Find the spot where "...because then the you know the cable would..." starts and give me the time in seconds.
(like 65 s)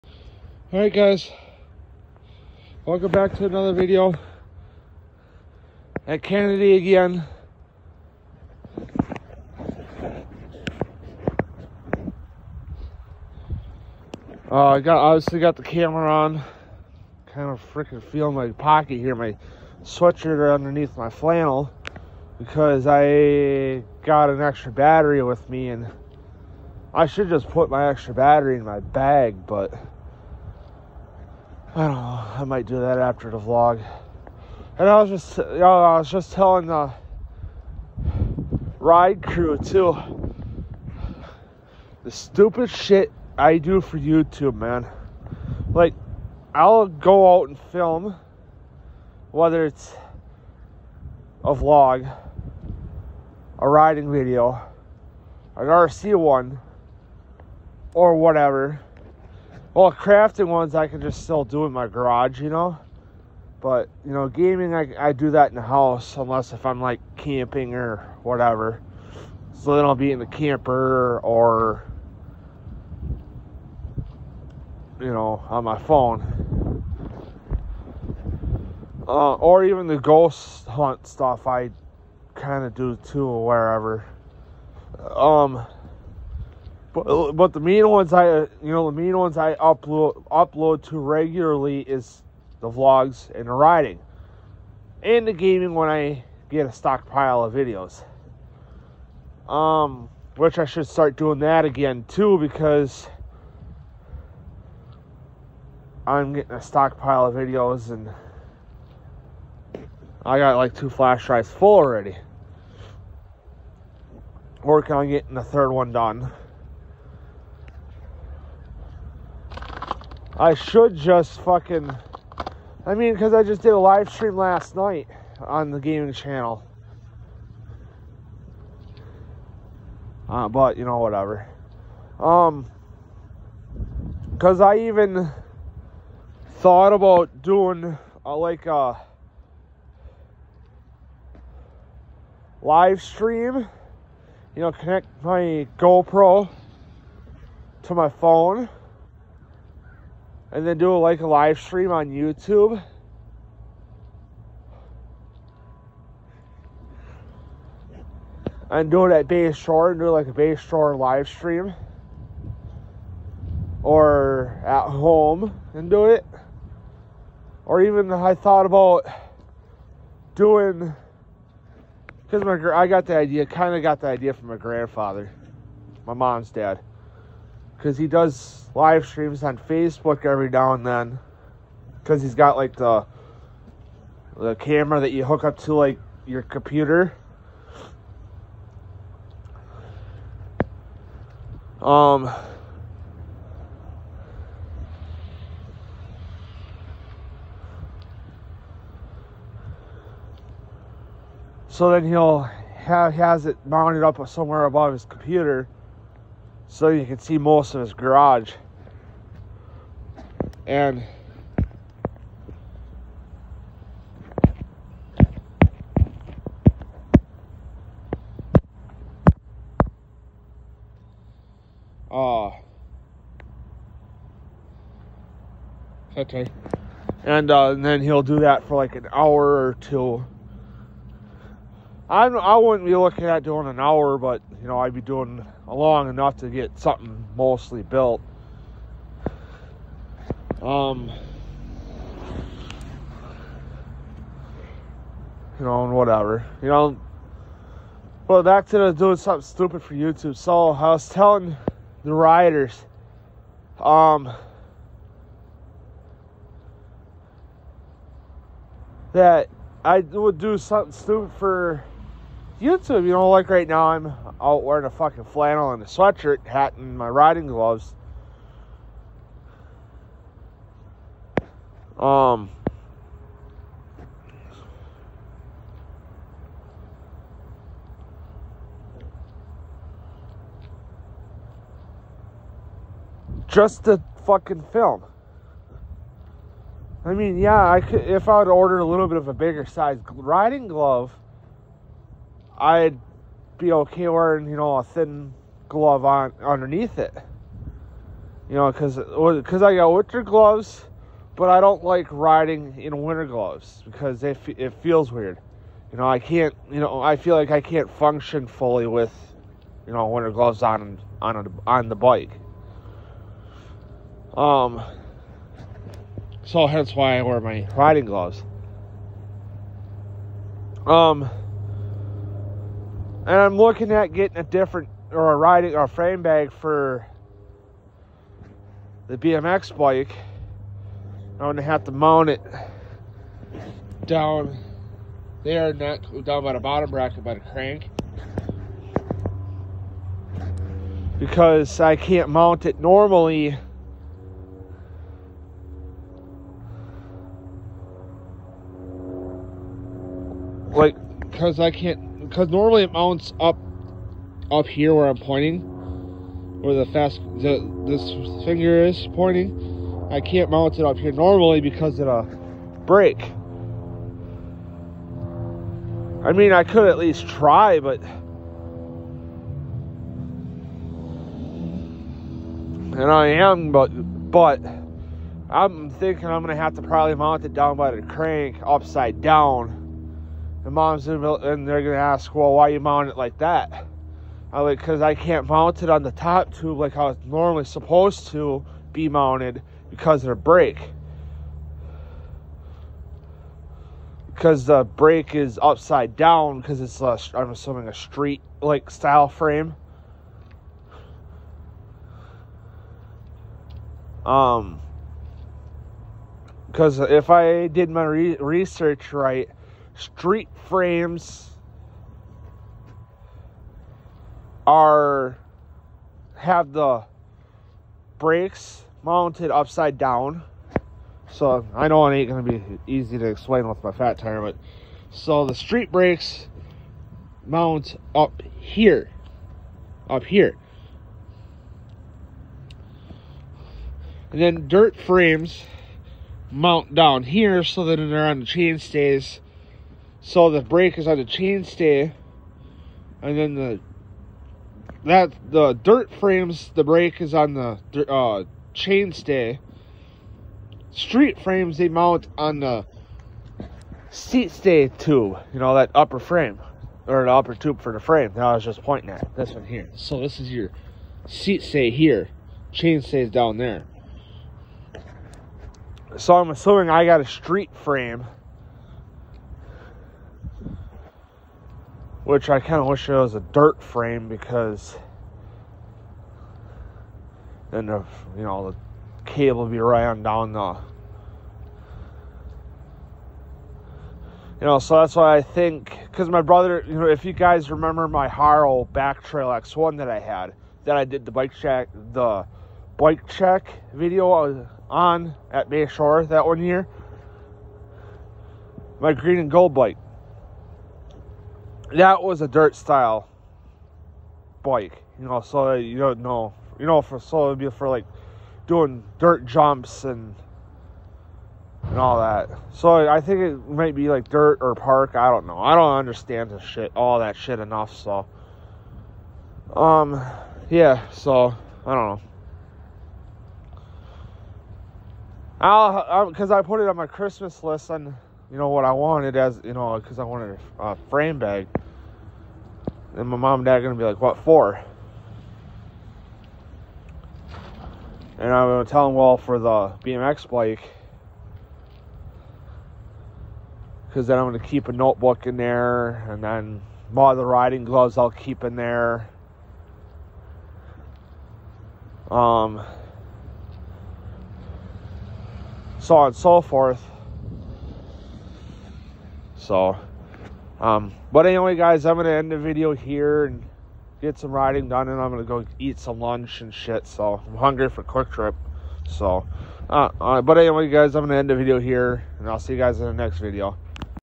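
474 s.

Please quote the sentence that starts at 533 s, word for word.
And my mom and dad are going to be like, what for?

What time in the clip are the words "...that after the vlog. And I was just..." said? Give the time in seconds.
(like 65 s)
32 s.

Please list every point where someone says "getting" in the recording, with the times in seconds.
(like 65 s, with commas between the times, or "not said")
106 s, 115 s, 324 s.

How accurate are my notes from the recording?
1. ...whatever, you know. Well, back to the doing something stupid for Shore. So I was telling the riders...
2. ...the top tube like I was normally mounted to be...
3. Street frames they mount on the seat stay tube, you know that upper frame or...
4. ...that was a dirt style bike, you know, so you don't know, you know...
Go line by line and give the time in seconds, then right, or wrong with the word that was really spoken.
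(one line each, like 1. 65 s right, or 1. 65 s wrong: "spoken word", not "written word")
1. 245 s wrong: "YouTube", not "Shore"
2. 386 s wrong: "supposed", not "mounted"
3. 450 s right
4. 501 s right.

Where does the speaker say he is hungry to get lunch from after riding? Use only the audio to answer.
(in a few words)
QuikTrip.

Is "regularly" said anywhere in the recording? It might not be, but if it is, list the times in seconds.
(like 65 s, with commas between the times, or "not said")
90 s.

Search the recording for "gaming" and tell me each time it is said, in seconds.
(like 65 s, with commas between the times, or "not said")
64 s, 95 s, 125 s.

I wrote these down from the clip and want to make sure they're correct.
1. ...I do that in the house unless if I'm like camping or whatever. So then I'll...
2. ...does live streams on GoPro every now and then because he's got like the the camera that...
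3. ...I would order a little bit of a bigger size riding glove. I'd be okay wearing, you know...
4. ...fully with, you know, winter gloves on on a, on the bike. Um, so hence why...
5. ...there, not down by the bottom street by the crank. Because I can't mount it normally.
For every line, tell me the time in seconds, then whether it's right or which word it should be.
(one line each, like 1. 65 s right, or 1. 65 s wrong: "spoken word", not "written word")
1. 64 s right
2. 178 s wrong: "Facebook", not "GoPro"
3. 288 s right
4. 308 s right
5. 335 s wrong: "bracket", not "street".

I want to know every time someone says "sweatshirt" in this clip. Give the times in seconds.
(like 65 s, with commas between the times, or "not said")
19 s, 265 s.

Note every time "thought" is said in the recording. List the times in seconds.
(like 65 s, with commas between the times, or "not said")
136 s, 168 s.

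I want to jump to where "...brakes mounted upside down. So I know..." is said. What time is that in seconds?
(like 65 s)
418 s.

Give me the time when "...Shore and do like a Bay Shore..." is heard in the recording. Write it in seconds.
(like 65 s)
159 s.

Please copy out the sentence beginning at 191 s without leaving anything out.
Um, so then he'll have has it mounted up somewhere above his computer so you can see most of his garage.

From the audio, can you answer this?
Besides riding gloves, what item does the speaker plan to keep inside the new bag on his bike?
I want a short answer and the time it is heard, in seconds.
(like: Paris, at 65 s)
A notebook, at 544 s.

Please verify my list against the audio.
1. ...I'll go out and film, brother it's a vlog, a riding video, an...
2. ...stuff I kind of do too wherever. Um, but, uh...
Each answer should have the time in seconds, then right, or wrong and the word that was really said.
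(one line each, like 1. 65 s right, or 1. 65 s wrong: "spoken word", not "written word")
1. 46 s wrong: "whether", not "brother"
2. 81 s right.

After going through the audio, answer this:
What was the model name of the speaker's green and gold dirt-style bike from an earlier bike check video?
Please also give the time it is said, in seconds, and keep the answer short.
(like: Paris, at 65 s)
Haro Backtrail X1, at 488 s.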